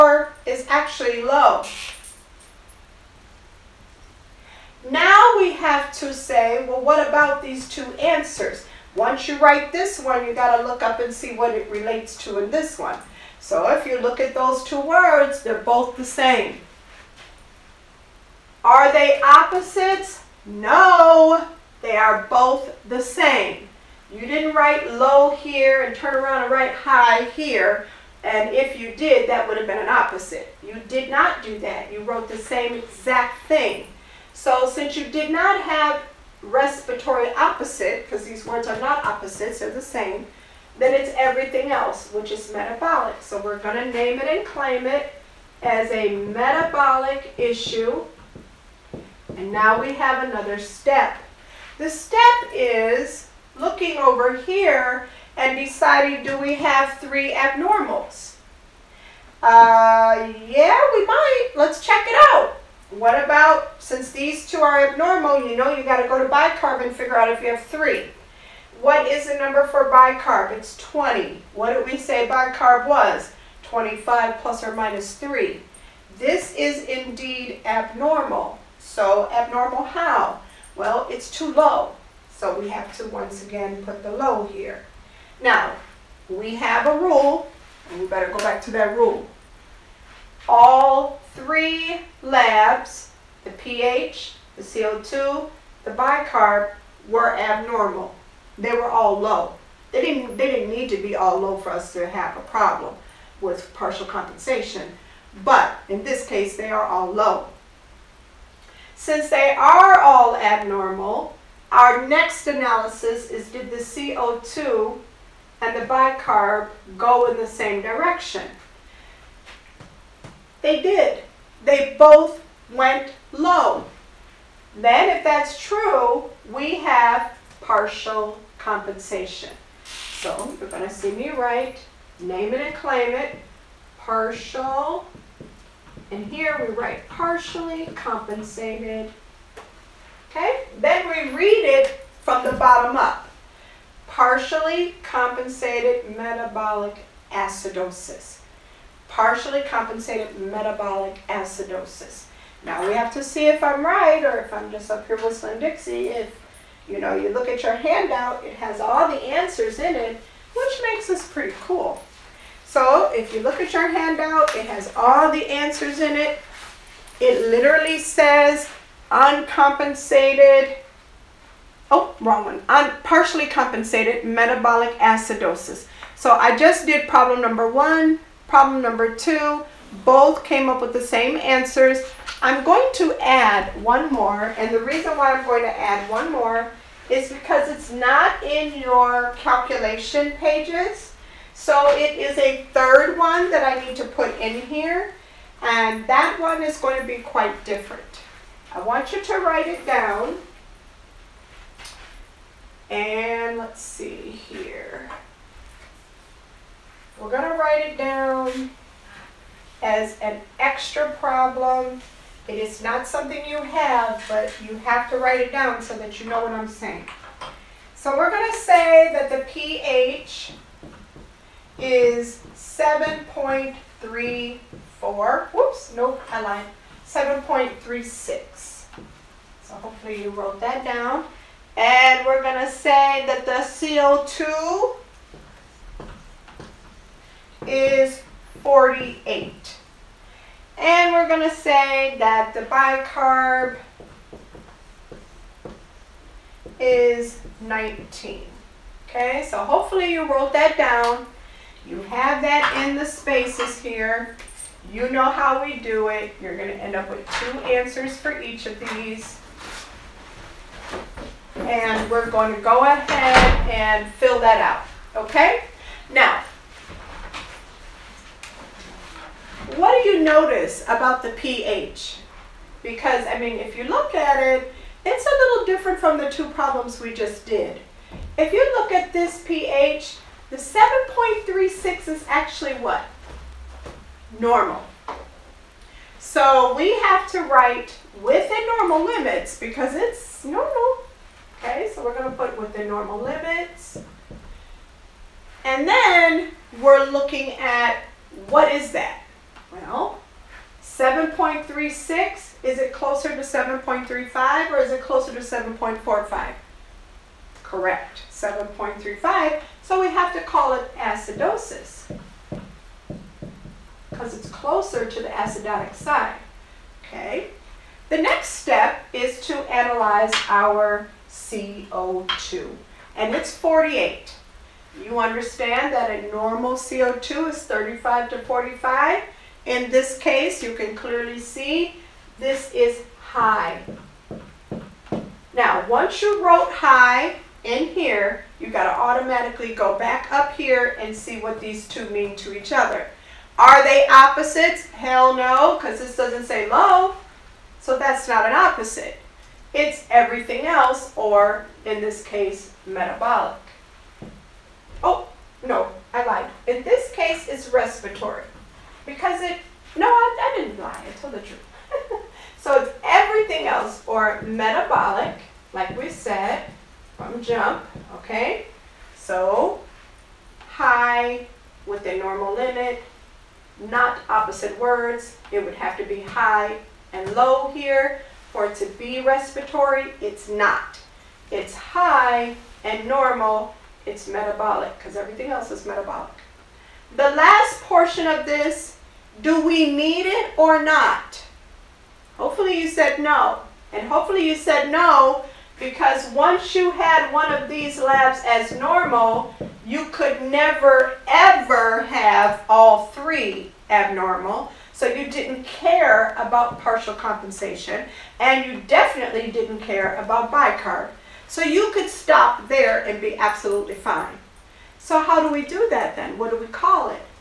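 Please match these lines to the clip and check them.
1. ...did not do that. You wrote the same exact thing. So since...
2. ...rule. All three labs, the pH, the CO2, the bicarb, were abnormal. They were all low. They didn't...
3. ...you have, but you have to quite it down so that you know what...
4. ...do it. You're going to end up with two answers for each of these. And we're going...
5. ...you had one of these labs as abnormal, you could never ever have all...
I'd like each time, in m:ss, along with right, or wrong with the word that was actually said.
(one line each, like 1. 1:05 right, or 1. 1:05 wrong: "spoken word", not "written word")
1. 0:30 right
2. 1:28 right
3. 3:33 wrong: "write", not "quite"
4. 4:15 right
5. 6:36 wrong: "normal", not "abnormal".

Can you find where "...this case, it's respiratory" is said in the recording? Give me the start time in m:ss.
5:56.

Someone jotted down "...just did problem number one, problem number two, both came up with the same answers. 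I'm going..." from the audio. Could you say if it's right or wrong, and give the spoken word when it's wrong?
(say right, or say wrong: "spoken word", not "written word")
right.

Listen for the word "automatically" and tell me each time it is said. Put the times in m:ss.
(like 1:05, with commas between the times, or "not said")
5:38.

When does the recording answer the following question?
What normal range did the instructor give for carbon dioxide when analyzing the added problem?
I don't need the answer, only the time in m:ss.
5:27.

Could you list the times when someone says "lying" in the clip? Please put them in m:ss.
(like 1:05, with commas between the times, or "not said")
not said.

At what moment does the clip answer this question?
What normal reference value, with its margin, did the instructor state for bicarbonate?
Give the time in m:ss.
1:13.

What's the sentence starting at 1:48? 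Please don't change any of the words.
Since they are all abnormal, our next analysis is did the CO2 and the bicarb go in the same direction?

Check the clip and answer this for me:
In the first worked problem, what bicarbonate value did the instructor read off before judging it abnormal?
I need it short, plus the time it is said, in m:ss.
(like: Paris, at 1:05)
20, at 1:10.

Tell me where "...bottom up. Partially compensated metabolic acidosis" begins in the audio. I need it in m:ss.
2:22.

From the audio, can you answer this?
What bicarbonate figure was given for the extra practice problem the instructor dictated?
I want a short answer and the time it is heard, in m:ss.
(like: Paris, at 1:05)
19, at 4:06.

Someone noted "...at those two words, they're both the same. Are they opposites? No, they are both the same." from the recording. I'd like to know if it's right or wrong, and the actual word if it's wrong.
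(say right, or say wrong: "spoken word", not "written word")
right.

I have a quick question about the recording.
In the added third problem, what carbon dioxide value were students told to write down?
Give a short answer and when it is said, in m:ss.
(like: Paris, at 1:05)
48, at 3:53.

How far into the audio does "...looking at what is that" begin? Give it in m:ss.
4:57.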